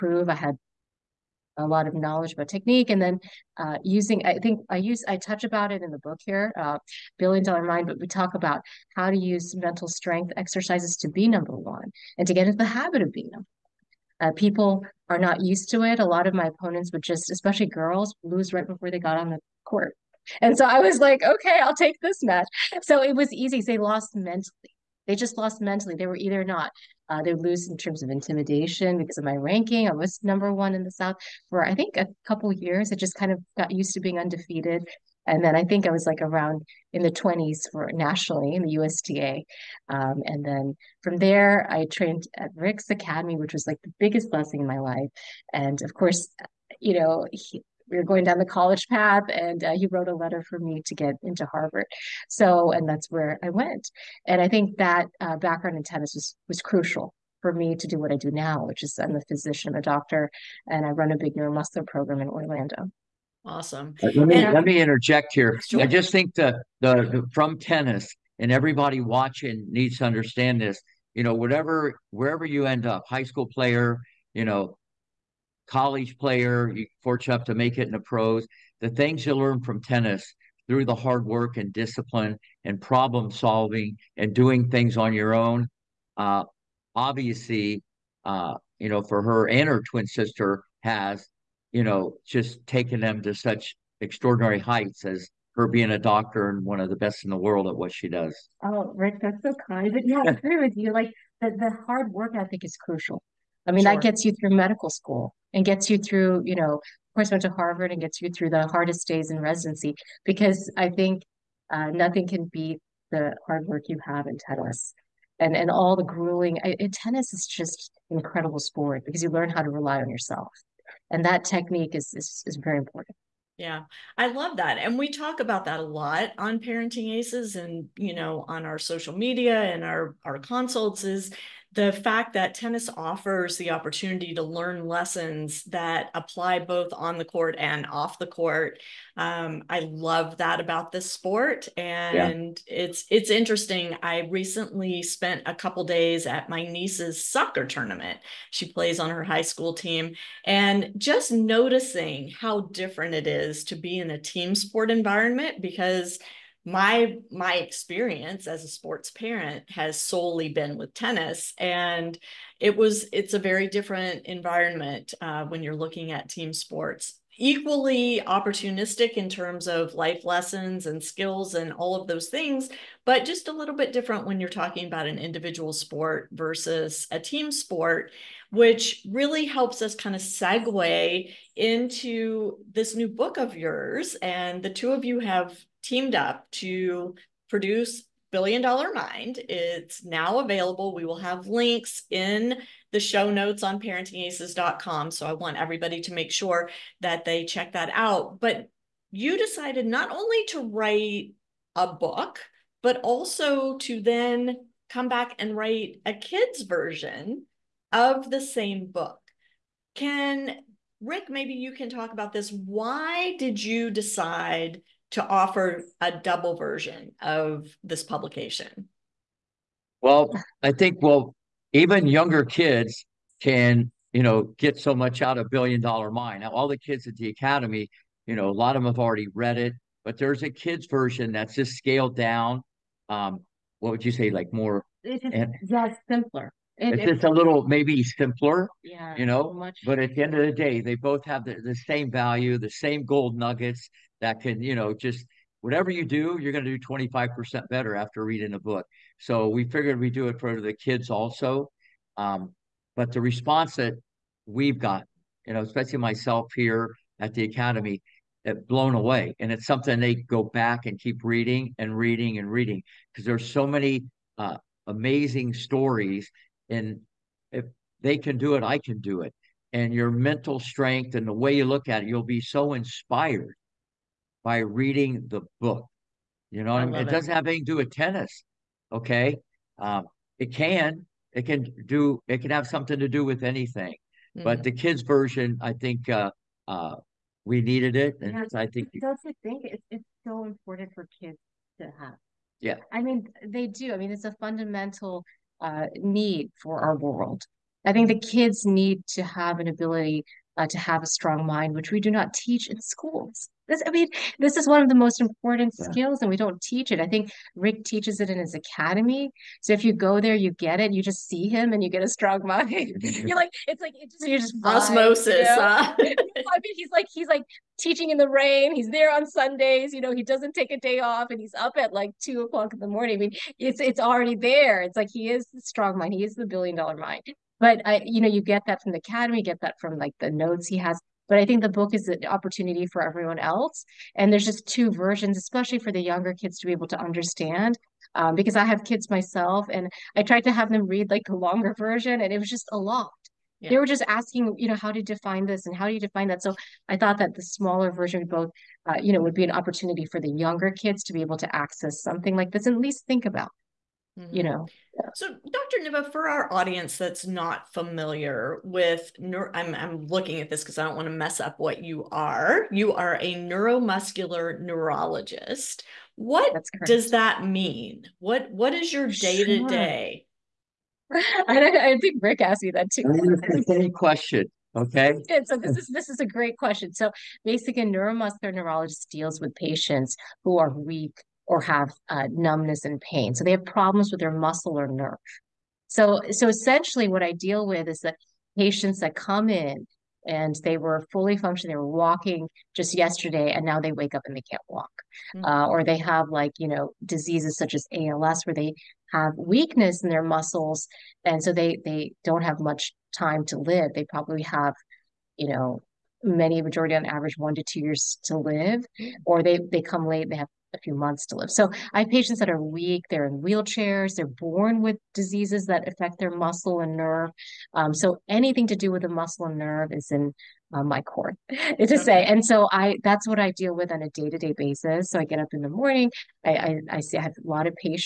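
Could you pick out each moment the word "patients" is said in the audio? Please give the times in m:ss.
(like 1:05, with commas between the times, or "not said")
6:19, 6:28, 6:52.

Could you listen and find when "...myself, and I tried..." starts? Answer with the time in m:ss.
5:39.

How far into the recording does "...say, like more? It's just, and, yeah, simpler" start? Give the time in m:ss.
3:54.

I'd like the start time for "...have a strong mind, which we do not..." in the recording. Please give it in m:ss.
5:00.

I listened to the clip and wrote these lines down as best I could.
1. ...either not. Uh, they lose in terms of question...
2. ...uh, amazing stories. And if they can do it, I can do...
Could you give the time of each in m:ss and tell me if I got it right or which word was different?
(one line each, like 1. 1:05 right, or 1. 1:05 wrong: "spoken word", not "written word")
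1. 0:26 wrong: "intimidation", not "question"
2. 4:24 right.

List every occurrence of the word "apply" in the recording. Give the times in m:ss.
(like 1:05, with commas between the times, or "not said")
2:16.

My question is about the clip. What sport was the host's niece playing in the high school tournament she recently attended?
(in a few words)
Soccer.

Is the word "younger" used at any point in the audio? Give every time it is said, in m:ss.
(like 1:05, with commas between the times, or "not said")
3:42, 5:36, 5:50.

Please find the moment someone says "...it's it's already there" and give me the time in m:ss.
5:23.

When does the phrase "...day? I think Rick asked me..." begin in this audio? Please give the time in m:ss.
6:09.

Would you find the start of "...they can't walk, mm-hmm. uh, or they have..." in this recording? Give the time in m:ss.
6:34.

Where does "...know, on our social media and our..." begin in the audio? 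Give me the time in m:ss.
2:08.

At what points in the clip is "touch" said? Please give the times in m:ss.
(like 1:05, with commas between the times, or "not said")
0:05.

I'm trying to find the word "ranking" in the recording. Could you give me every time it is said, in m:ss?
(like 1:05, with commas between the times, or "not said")
0:29.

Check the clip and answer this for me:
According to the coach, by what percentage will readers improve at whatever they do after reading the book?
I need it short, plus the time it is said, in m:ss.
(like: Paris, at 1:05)
25%, at 4:06.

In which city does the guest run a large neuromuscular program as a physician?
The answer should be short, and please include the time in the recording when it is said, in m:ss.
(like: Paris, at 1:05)
Orlando, at 1:02.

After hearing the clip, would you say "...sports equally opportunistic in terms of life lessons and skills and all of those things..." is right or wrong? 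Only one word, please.
right.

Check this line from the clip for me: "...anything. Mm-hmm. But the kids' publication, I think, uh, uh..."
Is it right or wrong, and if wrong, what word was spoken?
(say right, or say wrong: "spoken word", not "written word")
wrong: "version", not "publication".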